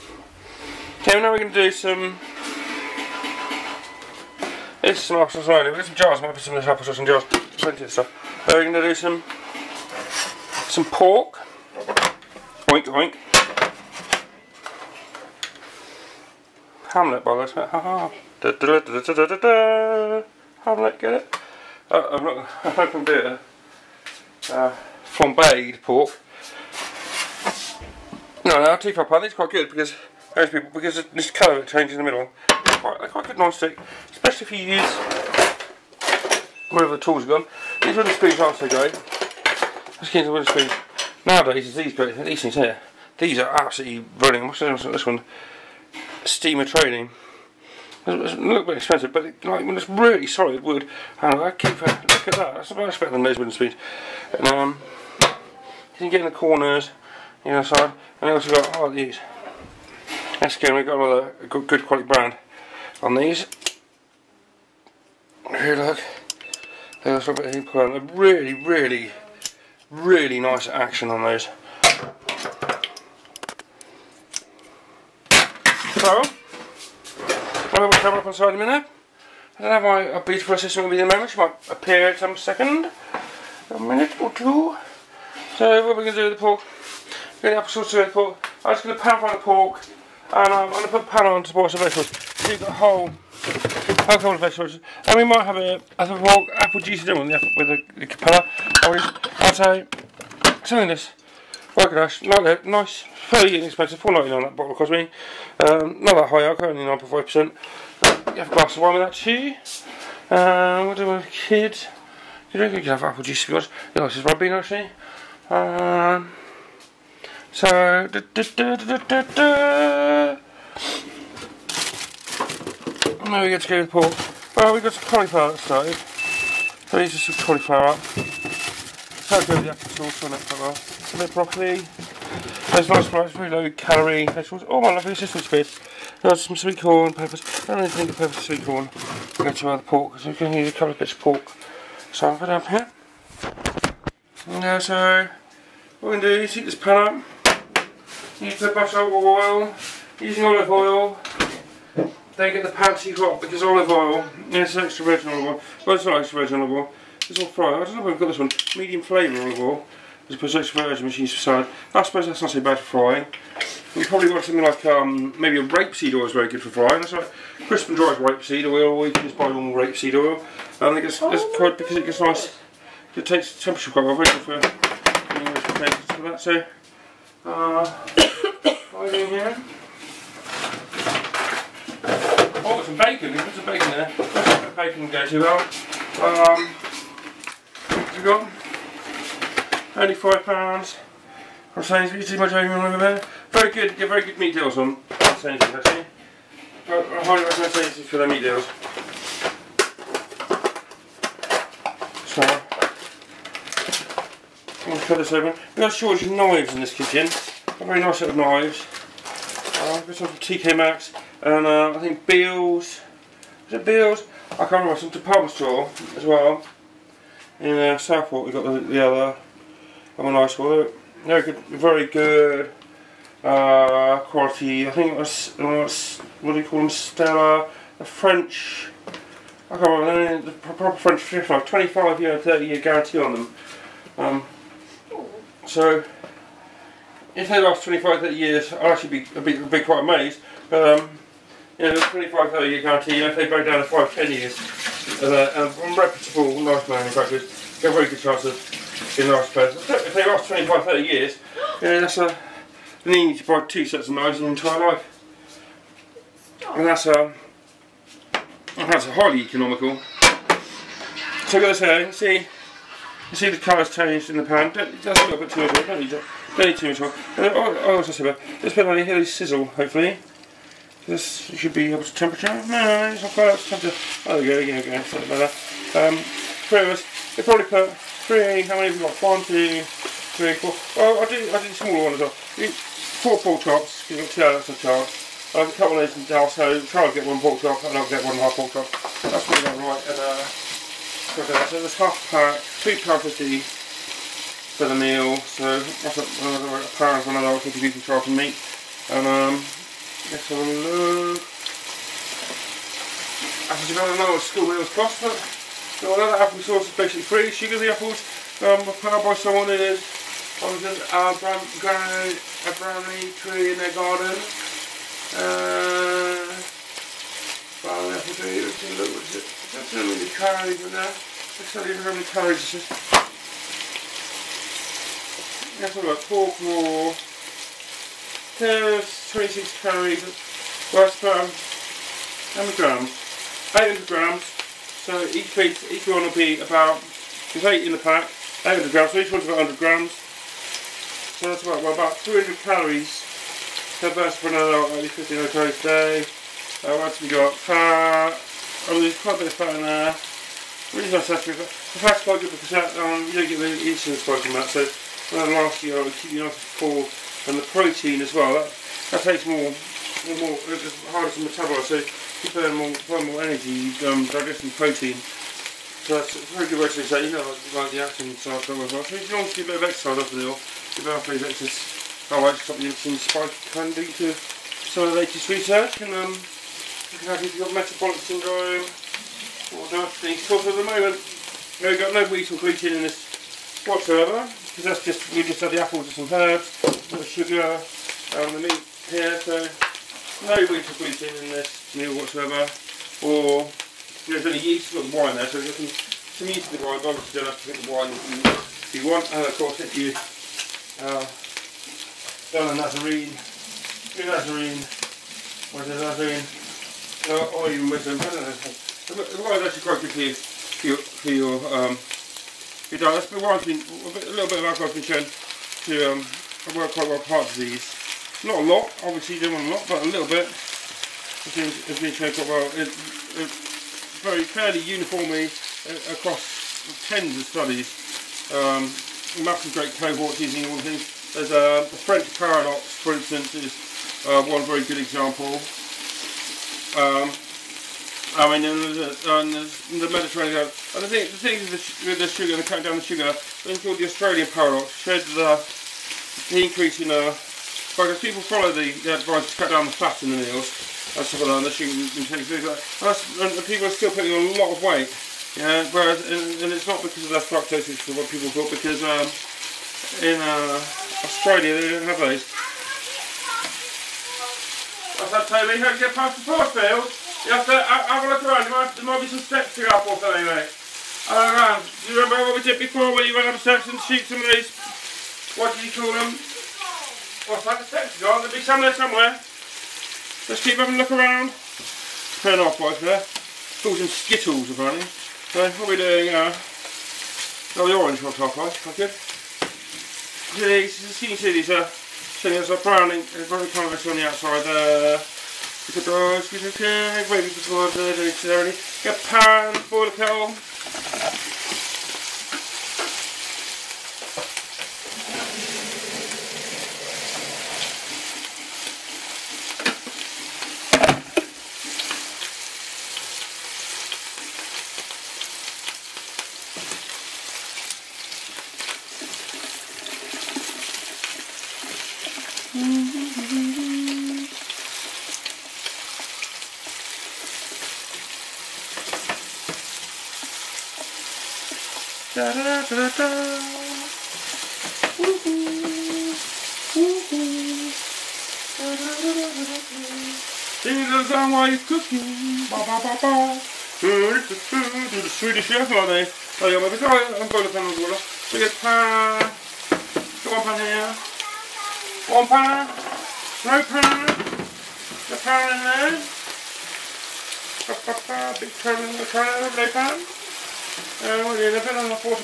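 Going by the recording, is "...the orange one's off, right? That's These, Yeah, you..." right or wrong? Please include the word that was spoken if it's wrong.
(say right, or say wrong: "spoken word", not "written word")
right.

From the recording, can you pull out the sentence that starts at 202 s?
So, I'm going to cut this open.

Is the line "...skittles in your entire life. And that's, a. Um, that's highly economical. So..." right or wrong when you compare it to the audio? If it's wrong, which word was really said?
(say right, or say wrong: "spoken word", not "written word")
wrong: "knives", not "skittles".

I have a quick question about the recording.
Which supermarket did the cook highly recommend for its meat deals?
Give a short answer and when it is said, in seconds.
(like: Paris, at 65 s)
Sainsbury's, at 195 s.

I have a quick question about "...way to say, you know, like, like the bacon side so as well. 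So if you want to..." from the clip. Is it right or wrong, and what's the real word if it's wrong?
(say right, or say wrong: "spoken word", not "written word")
wrong: "action", not "bacon".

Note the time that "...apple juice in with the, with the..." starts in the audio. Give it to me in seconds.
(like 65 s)
96 s.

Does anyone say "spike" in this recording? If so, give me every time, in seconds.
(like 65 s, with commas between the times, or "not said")
354 s, 373 s.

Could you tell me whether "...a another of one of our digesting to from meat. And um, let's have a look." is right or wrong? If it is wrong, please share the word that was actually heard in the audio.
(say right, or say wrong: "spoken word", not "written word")
wrong: "contributing", not "digesting".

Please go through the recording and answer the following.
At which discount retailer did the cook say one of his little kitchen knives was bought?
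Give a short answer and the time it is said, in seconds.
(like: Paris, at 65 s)
TK Maxx, at 210 s.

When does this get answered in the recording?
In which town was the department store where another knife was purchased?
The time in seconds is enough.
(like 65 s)
217 s.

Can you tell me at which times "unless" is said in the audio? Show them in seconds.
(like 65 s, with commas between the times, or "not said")
not said.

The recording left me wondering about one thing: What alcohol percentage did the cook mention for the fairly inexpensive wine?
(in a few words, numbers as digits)
9.5%.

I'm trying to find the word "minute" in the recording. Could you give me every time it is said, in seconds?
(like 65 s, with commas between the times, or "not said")
78 s, 83 s.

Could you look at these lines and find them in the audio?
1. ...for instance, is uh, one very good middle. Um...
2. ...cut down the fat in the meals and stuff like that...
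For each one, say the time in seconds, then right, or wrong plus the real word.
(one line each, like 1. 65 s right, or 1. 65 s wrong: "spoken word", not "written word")
1. 432 s wrong: "example", not "middle"
2. 449 s right.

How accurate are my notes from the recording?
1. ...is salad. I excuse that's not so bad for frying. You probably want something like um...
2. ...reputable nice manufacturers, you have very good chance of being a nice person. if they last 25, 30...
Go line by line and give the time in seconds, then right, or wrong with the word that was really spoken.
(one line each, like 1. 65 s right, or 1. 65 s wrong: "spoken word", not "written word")
1. 161 s wrong: "suppose", not "excuse"
2. 245 s right.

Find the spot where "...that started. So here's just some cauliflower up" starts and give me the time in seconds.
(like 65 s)
125 s.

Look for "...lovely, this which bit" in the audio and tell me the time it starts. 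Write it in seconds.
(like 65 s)
134 s.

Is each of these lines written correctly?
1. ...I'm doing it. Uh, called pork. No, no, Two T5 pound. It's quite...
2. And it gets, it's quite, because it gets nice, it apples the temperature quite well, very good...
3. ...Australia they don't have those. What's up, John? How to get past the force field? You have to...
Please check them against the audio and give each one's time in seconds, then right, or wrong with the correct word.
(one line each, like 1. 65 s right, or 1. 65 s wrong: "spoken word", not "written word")
1. 22 s wrong: "flambéed", not "called"
2. 170 s wrong: "takes", not "apples"
3. 461 s wrong: "Toby", not "John".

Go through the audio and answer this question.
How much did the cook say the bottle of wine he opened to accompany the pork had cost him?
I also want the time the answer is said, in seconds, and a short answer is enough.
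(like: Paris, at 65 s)
4.99, at 103 s.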